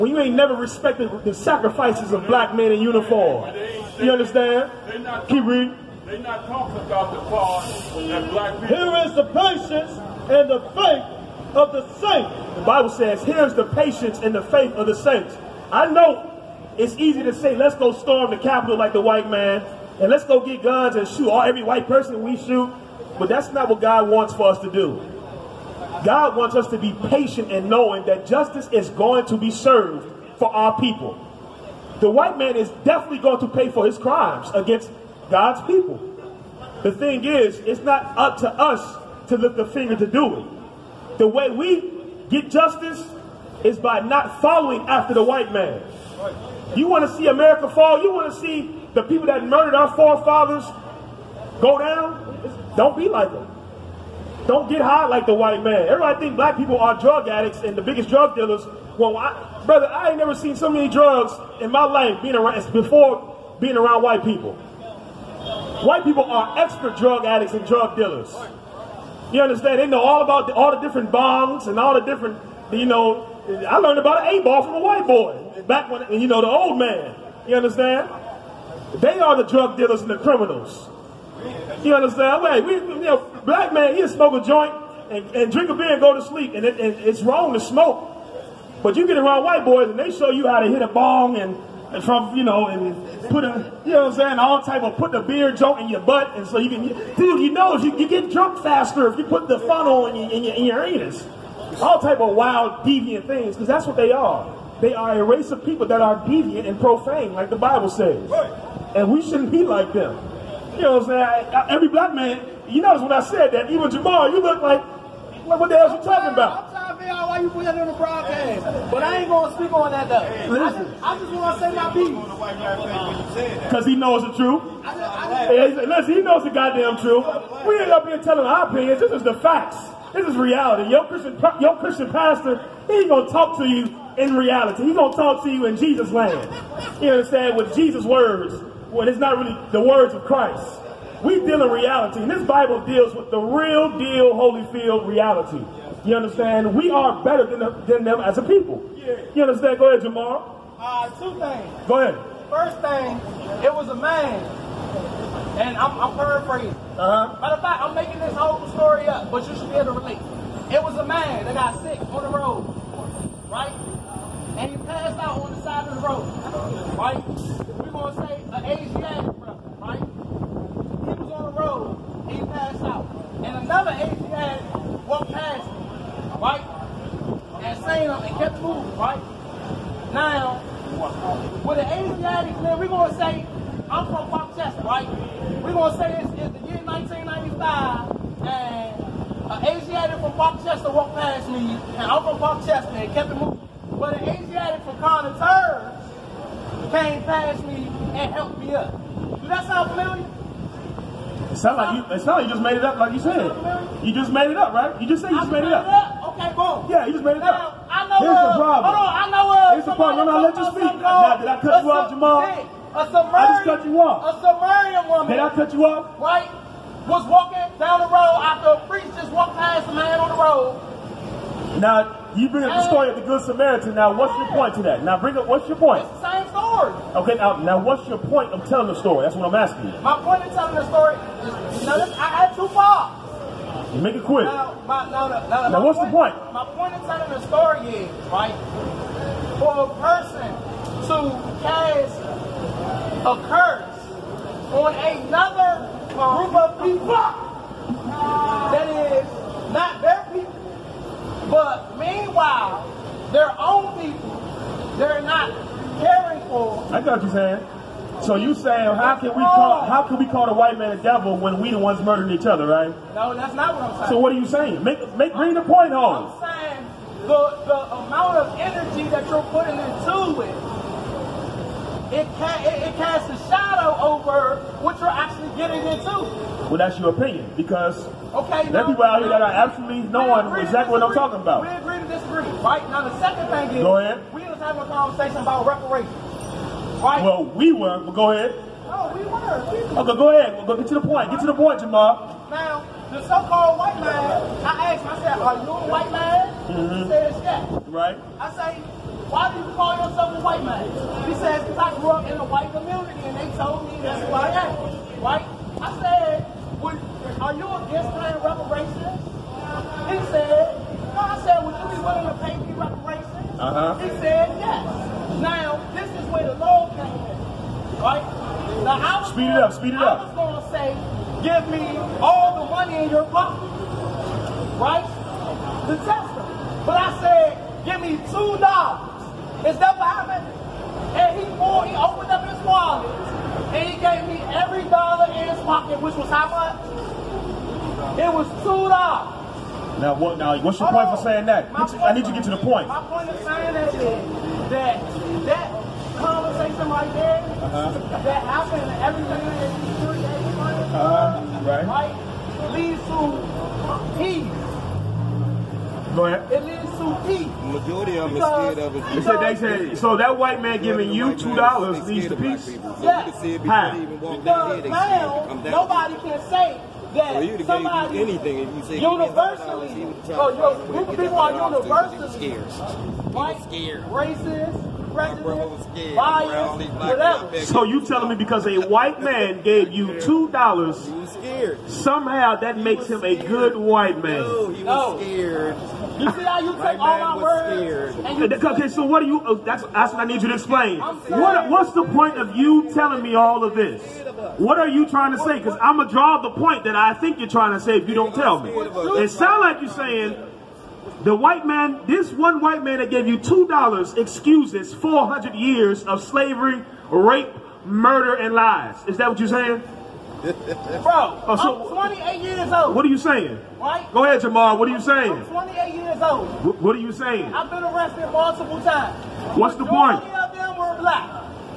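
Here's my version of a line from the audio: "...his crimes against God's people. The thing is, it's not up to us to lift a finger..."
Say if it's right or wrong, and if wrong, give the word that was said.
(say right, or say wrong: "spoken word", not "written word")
right.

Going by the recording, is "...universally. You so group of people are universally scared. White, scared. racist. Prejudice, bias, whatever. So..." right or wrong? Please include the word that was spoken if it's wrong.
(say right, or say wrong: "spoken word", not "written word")
right.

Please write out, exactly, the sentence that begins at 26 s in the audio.
God wants us to be patient in knowing that justice is going to be served for our people.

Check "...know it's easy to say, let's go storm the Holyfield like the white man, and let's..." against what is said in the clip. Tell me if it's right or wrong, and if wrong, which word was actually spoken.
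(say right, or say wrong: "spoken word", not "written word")
wrong: "Capitol", not "Holyfield".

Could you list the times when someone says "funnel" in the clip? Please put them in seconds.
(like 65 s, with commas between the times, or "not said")
99 s.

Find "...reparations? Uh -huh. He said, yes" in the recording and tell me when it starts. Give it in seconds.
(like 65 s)
312 s.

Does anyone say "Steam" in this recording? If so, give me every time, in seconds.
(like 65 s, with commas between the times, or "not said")
not said.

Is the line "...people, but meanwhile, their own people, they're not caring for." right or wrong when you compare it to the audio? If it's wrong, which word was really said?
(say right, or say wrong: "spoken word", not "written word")
right.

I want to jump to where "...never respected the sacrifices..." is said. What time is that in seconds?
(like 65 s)
0 s.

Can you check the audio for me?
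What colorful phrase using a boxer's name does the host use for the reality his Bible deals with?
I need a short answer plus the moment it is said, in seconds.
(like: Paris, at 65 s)
real deal Holyfield, at 143 s.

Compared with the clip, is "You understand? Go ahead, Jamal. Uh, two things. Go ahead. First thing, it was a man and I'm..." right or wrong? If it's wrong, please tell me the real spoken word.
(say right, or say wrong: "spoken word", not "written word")
right.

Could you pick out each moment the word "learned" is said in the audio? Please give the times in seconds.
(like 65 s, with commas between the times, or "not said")
73 s.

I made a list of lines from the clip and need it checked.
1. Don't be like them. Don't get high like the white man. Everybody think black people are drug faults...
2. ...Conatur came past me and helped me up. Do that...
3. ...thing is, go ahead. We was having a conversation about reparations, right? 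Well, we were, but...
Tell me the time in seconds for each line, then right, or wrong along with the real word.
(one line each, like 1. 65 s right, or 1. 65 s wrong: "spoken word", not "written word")
1. 52 s wrong: "addicts", not "faults"
2. 194 s right
3. 283 s right.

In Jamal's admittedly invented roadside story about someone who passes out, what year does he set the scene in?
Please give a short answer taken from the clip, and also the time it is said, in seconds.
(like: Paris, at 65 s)
1995, at 186 s.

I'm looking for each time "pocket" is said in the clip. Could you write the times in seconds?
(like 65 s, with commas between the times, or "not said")
323 s, 335 s.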